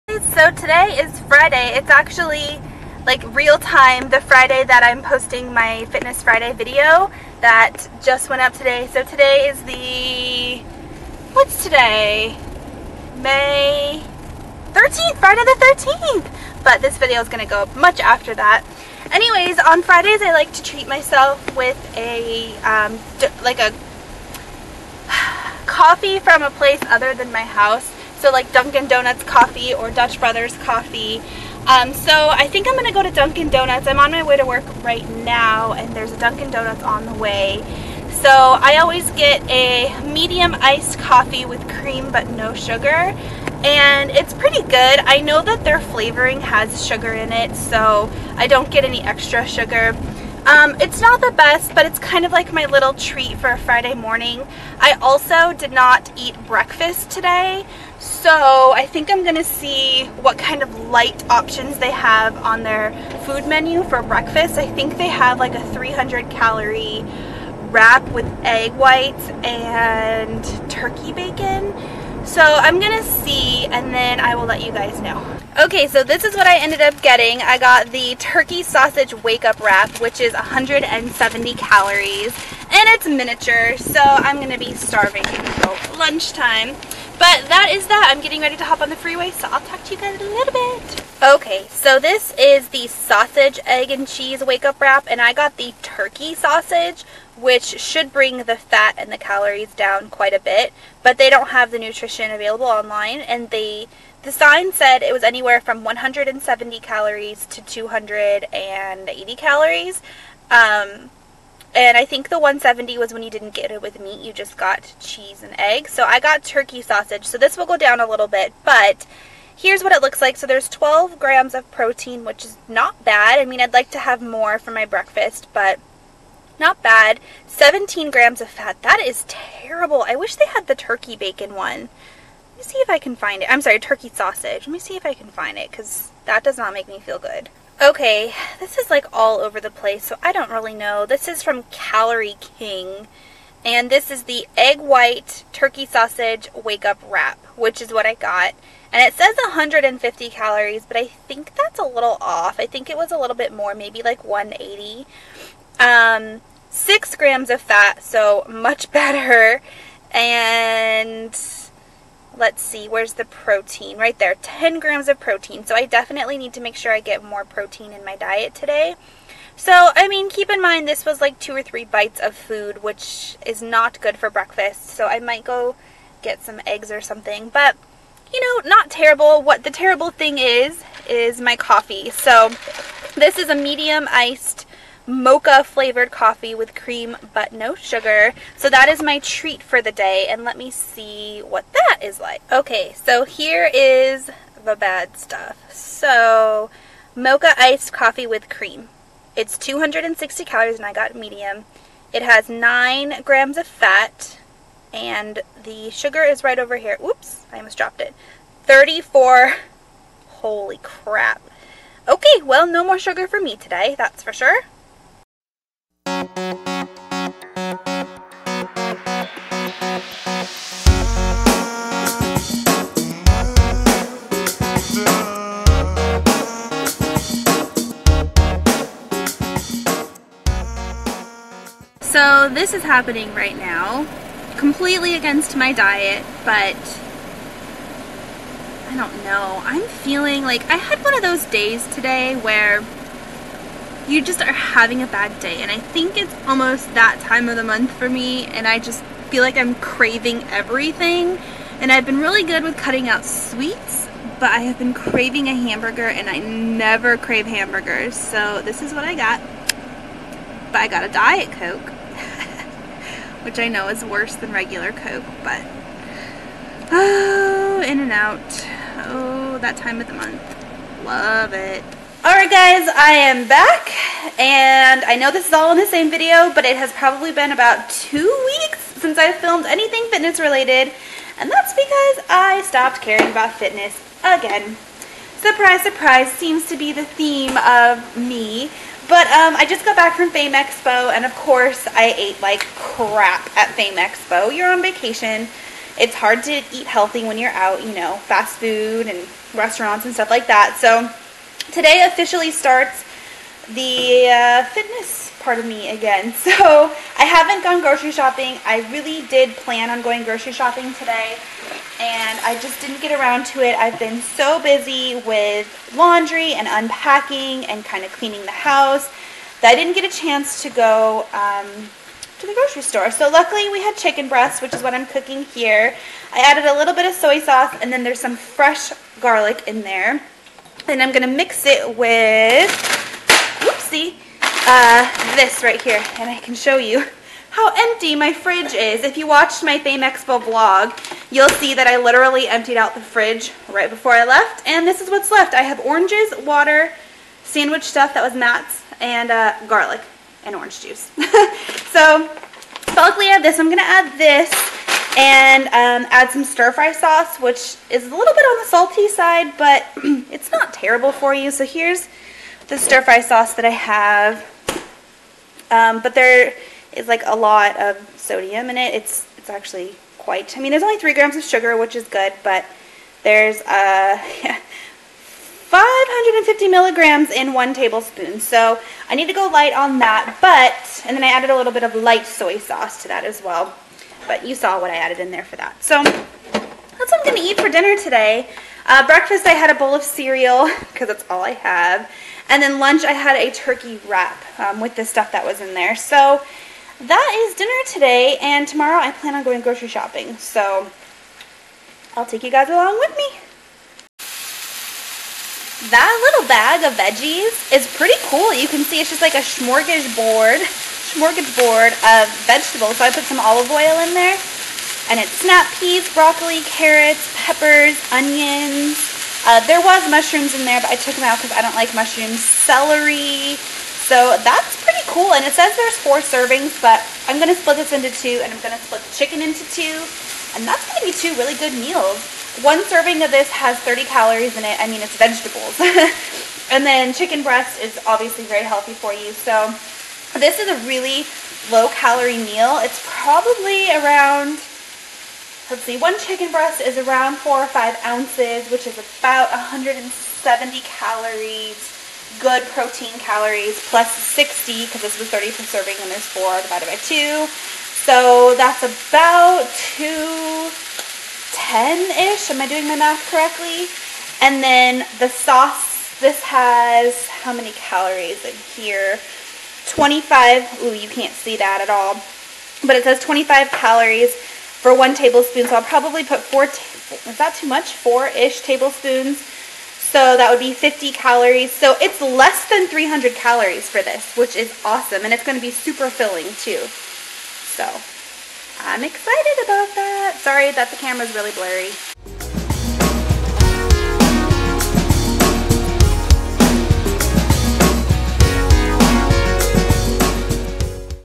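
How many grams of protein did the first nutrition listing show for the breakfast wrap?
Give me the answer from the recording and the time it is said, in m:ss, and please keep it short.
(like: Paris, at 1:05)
12, at 2:00.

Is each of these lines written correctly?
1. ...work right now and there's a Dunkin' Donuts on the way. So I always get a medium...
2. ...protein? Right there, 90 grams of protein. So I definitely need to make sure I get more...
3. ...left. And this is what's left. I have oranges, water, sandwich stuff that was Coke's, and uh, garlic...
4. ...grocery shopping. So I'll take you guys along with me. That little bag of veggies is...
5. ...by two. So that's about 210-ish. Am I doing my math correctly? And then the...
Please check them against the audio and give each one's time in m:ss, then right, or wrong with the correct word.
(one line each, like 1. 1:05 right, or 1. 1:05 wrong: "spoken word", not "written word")
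1. 0:34 right
2. 2:43 wrong: "10", not "90"
3. 5:44 wrong: "Matt", not "Coke"
4. 6:39 right
5. 7:36 right.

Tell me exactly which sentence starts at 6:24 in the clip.
But you saw what I added in there for that.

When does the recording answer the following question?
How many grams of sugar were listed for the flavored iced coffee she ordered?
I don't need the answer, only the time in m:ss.
3:28.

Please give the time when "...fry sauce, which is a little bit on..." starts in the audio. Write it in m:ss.
5:56.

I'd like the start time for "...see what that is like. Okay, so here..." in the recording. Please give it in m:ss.
3:10.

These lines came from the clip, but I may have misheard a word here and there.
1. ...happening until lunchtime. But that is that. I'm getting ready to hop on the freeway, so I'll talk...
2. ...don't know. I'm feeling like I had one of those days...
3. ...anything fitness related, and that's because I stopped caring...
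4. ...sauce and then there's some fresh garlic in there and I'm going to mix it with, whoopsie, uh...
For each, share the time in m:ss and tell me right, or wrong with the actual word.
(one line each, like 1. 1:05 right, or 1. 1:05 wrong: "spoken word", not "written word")
1. 1:24 wrong: "starving", not "happening"
2. 3:58 right
3. 4:39 right
4. 5:27 right.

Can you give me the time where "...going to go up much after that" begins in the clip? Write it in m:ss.
0:17.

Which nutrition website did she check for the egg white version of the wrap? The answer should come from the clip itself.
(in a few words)
Calorie King.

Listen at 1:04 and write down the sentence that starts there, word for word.
I think they have like a 300 calorie wrap with egg whites and turkey bacon.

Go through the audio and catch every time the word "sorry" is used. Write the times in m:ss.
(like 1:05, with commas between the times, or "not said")
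2:13, 8:10.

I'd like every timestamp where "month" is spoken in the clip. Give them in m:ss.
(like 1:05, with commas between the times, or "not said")
4:07, 4:30.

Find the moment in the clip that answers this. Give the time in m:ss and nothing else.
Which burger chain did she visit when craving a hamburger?
4:27.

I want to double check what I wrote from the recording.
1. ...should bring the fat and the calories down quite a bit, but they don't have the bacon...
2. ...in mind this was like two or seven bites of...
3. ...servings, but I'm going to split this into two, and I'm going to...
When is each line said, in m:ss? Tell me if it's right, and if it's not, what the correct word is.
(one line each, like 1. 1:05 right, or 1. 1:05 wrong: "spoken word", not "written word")
1. 1:37 wrong: "nutrition", not "bacon"
2. 2:50 wrong: "three", not "seven"
3. 7:06 right.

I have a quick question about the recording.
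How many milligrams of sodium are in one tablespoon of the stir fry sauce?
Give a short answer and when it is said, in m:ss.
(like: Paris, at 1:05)
550, at 6:15.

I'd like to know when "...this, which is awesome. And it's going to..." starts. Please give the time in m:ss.
8:04.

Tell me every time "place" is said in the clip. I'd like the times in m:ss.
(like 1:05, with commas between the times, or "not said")
0:26, 2:19.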